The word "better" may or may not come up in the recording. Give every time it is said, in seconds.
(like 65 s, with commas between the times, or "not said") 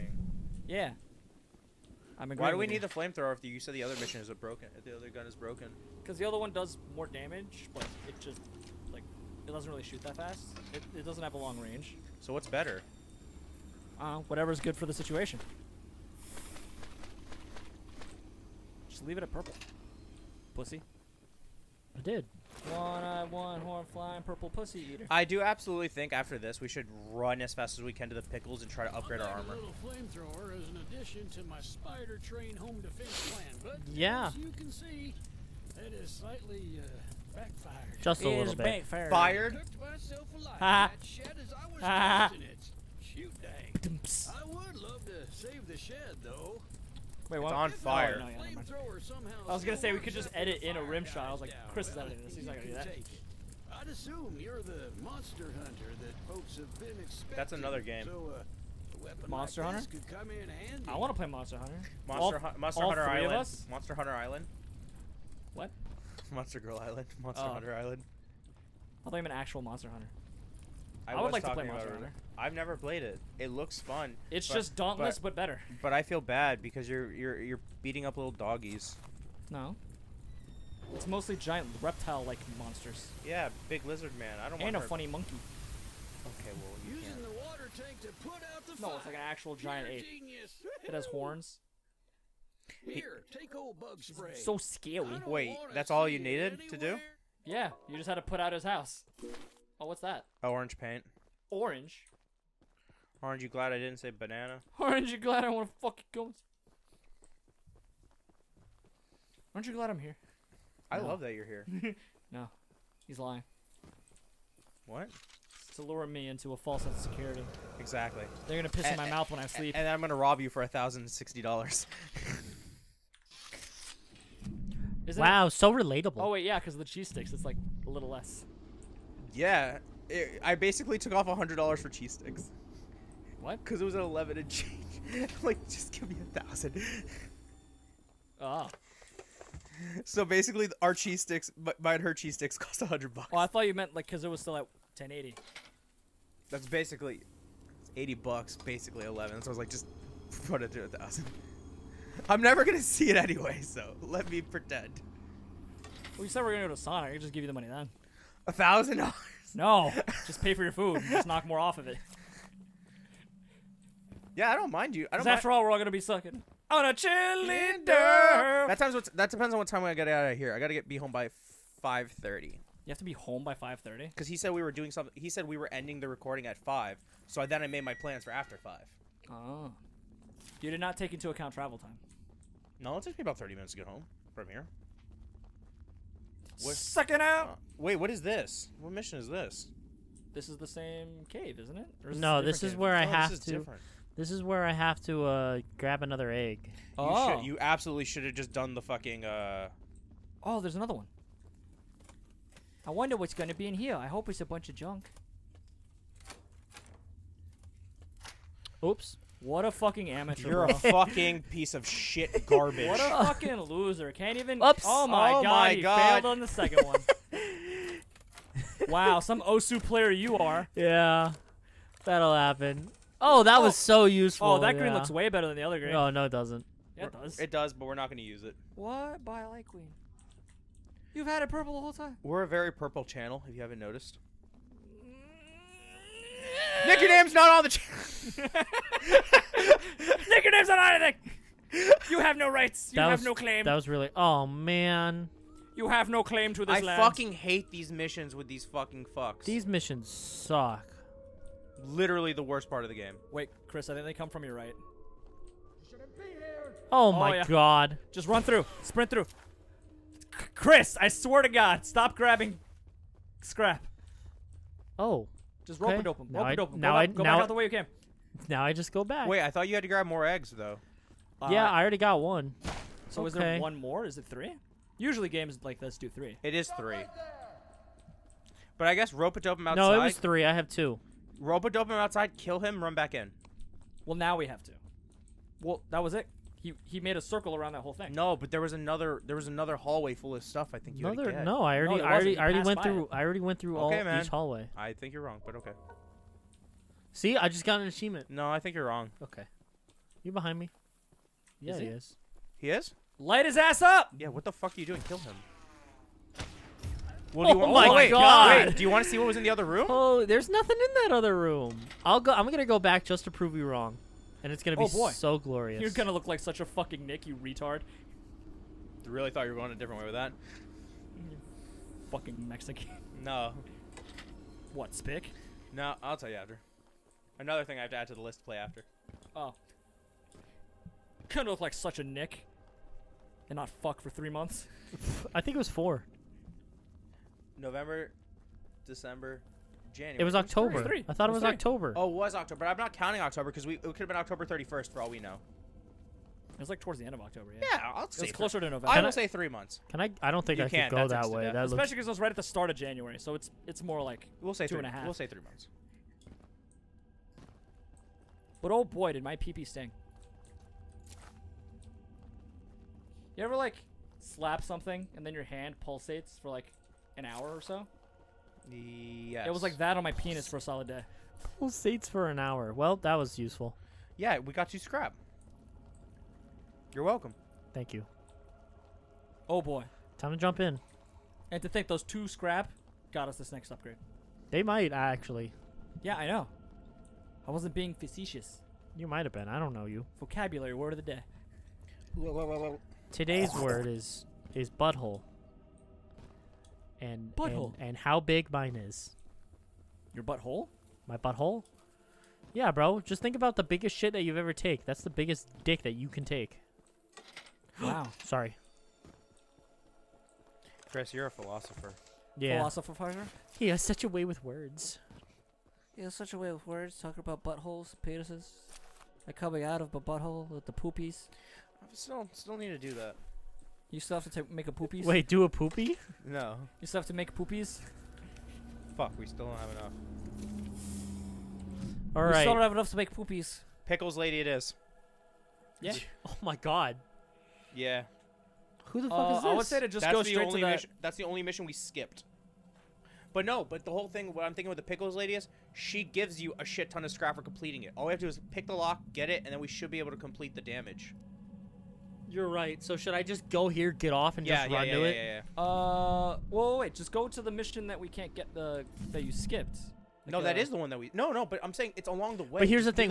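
12 s, 75 s, 225 s.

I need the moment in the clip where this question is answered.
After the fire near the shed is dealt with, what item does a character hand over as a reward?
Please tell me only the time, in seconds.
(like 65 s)
93 s.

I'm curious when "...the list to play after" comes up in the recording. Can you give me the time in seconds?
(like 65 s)
328 s.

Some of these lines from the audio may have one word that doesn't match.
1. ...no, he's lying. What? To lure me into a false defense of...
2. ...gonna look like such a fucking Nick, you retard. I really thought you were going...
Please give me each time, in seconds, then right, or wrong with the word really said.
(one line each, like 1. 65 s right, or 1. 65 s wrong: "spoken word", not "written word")
1. 112 s wrong: "sense", not "defense"
2. 315 s right.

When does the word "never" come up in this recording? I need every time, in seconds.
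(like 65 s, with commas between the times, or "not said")
72 s, 152 s.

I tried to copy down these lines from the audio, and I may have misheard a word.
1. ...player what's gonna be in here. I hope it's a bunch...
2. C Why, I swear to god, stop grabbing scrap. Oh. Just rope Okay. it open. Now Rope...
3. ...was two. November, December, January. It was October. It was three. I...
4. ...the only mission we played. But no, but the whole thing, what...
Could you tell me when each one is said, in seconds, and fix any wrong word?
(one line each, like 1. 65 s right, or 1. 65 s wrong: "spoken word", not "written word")
1. 202 s wrong: "wonder", not "player"
2. 259 s wrong: "Chris", not "Why"
3. 335 s wrong: "four", not "two"
4. 441 s wrong: "skipped", not "played".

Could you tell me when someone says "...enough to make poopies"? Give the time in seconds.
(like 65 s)
432 s.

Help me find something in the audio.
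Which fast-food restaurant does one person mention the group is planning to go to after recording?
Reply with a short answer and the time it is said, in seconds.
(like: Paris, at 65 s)
Sonic, at 156 s.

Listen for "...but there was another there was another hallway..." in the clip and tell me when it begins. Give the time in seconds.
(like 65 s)
288 s.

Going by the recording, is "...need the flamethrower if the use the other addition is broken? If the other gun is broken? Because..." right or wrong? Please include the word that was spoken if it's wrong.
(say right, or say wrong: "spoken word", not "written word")
wrong: "mission", not "addition".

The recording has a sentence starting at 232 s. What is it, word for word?
We're a very purple channel, if you haven't noticed.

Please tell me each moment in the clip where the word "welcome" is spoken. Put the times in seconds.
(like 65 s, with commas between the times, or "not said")
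377 s.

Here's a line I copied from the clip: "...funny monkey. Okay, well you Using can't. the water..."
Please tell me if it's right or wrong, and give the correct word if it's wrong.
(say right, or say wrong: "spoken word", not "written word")
right.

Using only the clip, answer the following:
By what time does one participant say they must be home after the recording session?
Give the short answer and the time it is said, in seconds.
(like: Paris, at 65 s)
5:30, at 173 s.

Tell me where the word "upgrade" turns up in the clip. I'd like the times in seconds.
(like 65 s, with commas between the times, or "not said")
28 s, 383 s.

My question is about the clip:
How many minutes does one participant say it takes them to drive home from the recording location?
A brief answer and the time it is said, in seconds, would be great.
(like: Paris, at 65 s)
30, at 183 s.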